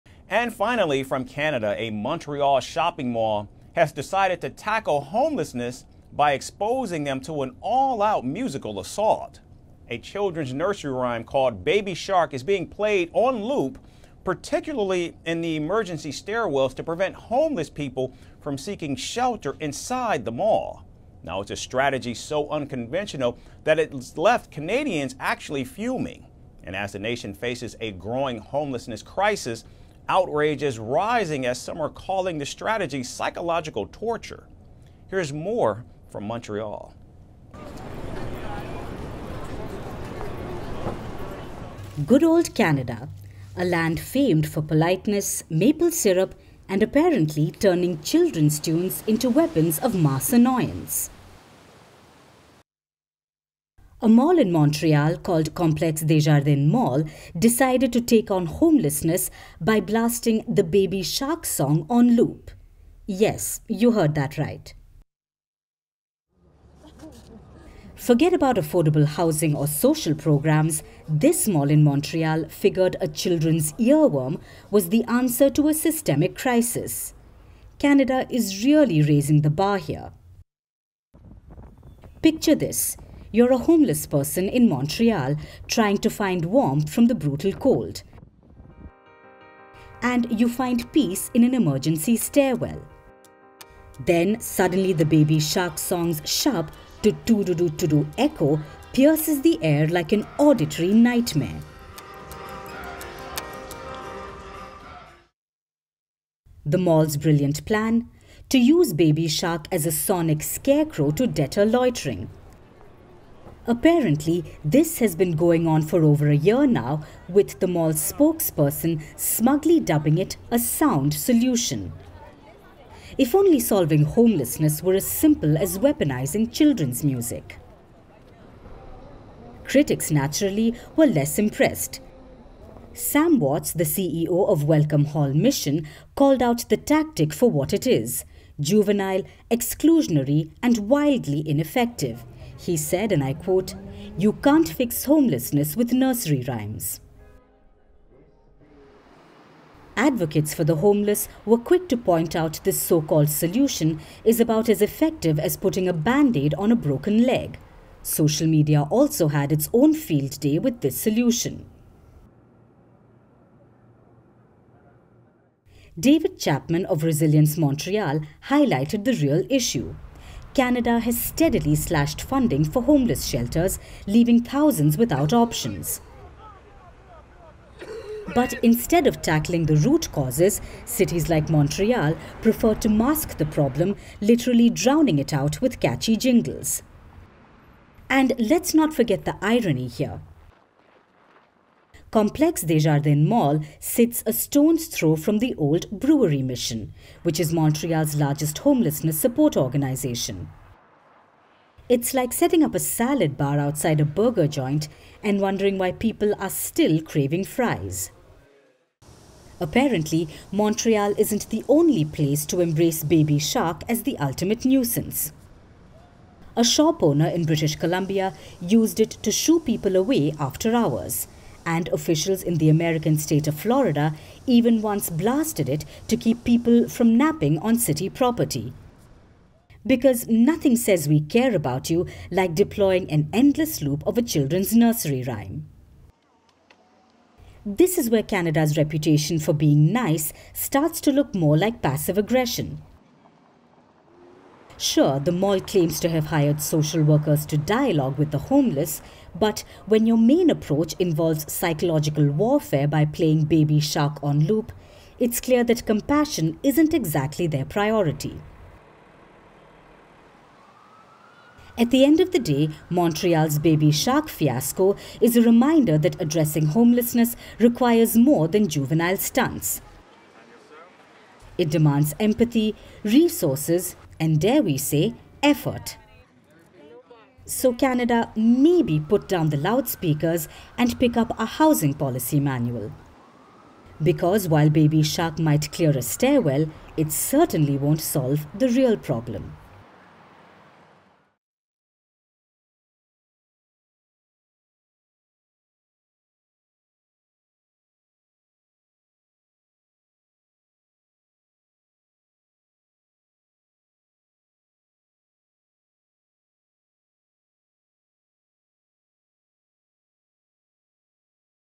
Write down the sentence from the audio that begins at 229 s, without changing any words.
Because nothing says we care about you like deploying an endless loop of a children's nursery rhyme.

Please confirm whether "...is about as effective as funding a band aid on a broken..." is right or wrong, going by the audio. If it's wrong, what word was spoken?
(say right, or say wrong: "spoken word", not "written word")
wrong: "putting", not "funding".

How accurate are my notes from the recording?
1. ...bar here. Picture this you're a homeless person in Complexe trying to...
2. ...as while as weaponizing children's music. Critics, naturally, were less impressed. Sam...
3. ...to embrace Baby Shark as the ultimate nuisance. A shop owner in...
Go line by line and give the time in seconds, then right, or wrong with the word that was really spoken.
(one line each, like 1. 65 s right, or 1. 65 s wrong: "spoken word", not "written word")
1. 79 s wrong: "Montreal", not "Complexe"
2. 124 s wrong: "simple", not "while"
3. 212 s right.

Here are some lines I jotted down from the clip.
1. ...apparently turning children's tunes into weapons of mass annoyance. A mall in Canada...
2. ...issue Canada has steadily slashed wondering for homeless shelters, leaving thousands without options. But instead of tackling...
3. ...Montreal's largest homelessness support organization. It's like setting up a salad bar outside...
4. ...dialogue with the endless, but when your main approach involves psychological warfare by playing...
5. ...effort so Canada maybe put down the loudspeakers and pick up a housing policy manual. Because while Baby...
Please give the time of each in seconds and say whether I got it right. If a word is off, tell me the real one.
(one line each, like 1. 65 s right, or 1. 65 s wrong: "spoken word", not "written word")
1. 46 s wrong: "Montreal", not "Canada"
2. 169 s wrong: "funding", not "wondering"
3. 197 s right
4. 247 s wrong: "homeless", not "endless"
5. 275 s right.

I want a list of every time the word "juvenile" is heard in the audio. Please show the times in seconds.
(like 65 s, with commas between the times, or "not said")
138 s, 268 s.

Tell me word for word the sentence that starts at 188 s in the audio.
And let's not forget the irony here.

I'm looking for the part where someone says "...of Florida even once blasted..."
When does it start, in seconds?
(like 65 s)
223 s.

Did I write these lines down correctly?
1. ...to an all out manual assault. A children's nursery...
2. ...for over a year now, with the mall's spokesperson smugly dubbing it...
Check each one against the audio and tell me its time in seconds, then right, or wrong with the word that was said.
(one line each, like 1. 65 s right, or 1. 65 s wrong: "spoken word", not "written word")
1. 7 s wrong: "musical", not "manual"
2. 115 s right.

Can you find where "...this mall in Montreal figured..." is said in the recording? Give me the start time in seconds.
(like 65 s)
71 s.